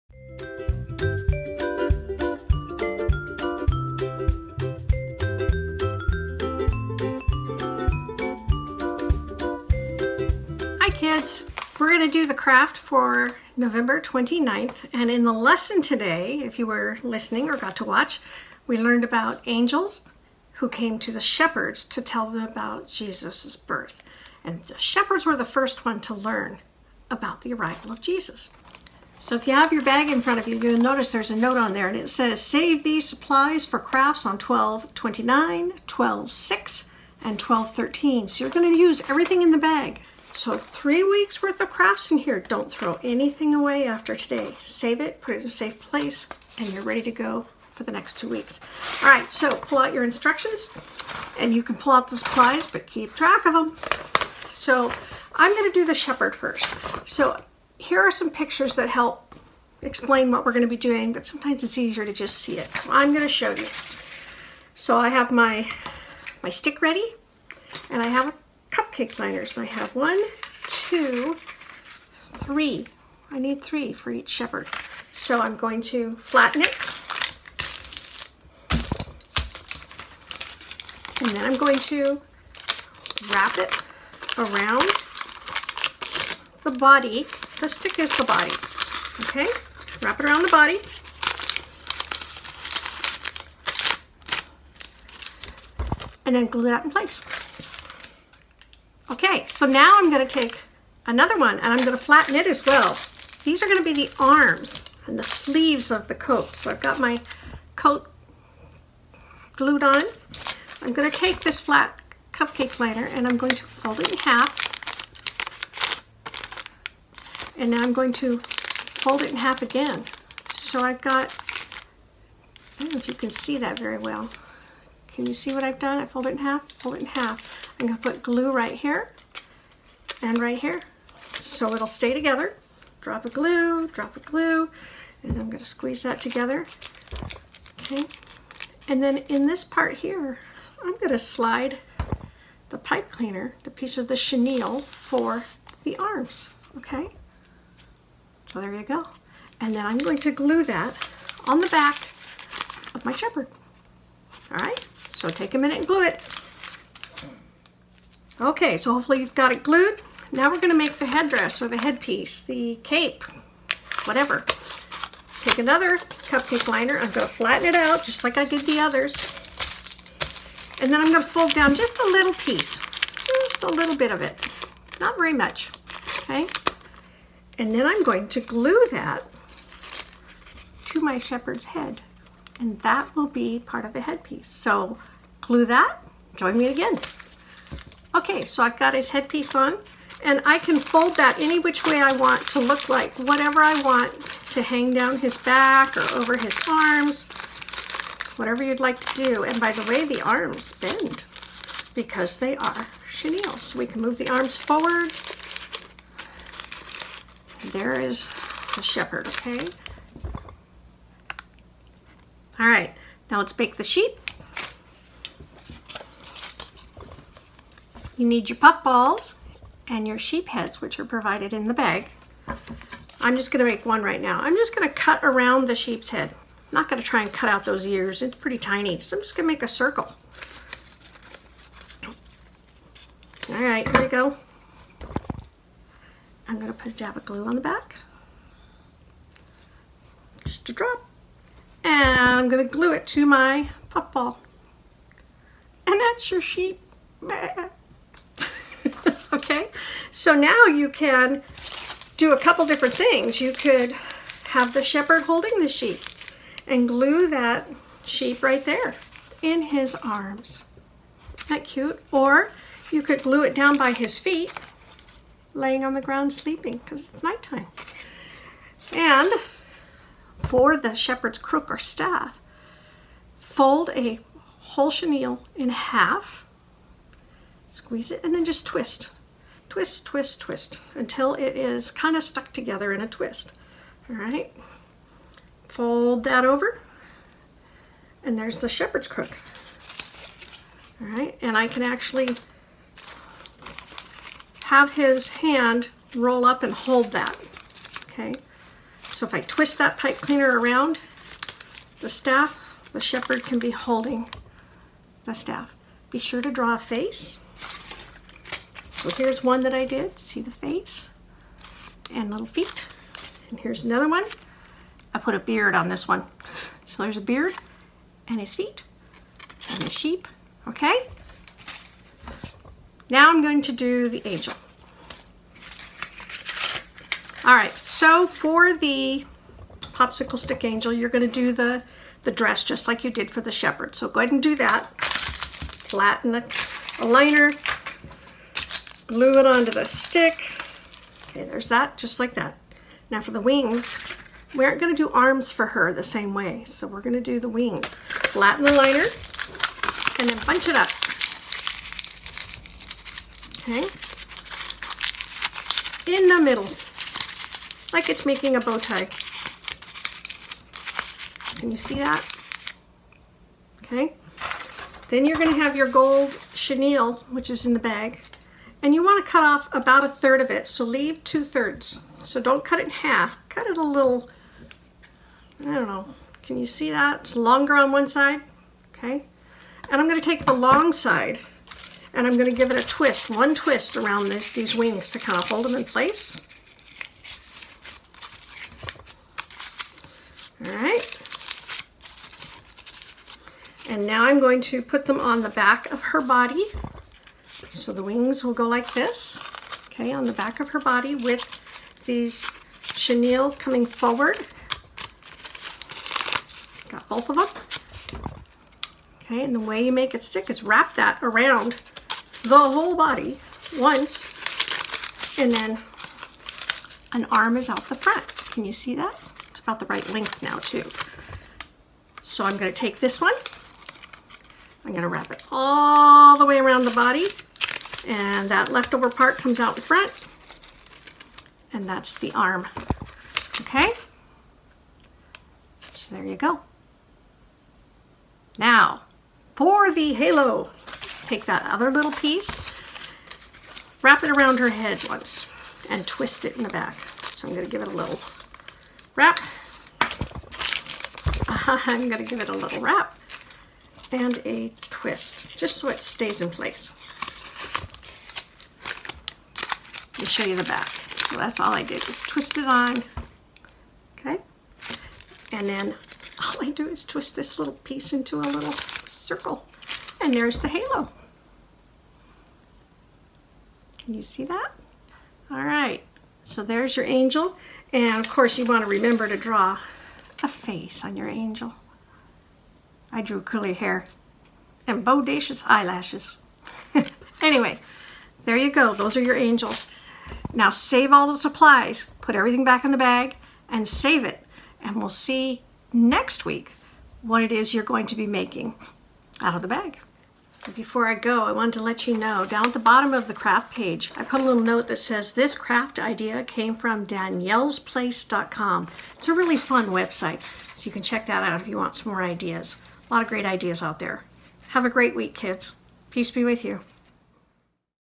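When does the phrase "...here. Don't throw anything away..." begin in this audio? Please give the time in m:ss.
0:42.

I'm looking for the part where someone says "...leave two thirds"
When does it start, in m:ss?
6:10.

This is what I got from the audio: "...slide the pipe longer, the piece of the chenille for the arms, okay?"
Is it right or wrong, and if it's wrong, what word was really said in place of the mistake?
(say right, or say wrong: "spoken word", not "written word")
wrong: "cleaner", not "longer".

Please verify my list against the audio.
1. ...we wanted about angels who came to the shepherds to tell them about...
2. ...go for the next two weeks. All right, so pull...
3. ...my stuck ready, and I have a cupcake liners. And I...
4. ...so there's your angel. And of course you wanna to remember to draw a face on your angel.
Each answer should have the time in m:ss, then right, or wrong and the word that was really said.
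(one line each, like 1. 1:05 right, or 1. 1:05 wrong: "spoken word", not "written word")
1. 0:18 wrong: "learned", not "wanted"
2. 0:47 right
3. 1:06 wrong: "stick", not "stuck"
4. 7:56 right.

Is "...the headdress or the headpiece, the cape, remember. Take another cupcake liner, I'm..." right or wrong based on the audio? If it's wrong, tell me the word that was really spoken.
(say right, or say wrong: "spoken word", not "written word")
wrong: "whatever", not "remember".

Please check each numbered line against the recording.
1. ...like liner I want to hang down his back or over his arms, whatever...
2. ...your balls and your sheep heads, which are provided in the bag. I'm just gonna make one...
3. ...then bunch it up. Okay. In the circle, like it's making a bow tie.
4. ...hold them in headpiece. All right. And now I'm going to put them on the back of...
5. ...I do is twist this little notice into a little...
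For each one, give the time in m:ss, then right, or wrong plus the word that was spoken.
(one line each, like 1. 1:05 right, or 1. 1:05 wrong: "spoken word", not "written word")
1. 3:12 wrong: "whatever", not "liner"
2. 3:38 right
3. 5:50 wrong: "middle", not "circle"
4. 6:25 wrong: "place", not "headpiece"
5. 7:46 wrong: "piece", not "notice".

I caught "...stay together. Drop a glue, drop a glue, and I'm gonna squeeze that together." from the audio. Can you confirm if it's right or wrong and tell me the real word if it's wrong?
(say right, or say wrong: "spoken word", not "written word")
right.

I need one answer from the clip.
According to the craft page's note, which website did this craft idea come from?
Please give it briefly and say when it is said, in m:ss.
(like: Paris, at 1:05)
daniellesplace.com, at 8:27.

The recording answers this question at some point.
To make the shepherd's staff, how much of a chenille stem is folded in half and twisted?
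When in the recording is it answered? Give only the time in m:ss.
4:33.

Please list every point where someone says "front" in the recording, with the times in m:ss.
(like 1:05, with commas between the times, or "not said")
0:30, 6:57, 7:09.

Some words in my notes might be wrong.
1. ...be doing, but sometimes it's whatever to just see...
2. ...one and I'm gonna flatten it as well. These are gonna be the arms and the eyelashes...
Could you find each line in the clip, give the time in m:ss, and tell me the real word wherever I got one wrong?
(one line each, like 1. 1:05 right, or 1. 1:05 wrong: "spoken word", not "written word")
1. 1:00 wrong: "easier", not "whatever"
2. 1:41 wrong: "sleeves", not "eyelashes".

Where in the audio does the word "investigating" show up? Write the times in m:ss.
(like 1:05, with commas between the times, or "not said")
not said.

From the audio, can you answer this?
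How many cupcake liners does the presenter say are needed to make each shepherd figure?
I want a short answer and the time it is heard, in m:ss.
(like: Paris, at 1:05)
3, at 1:13.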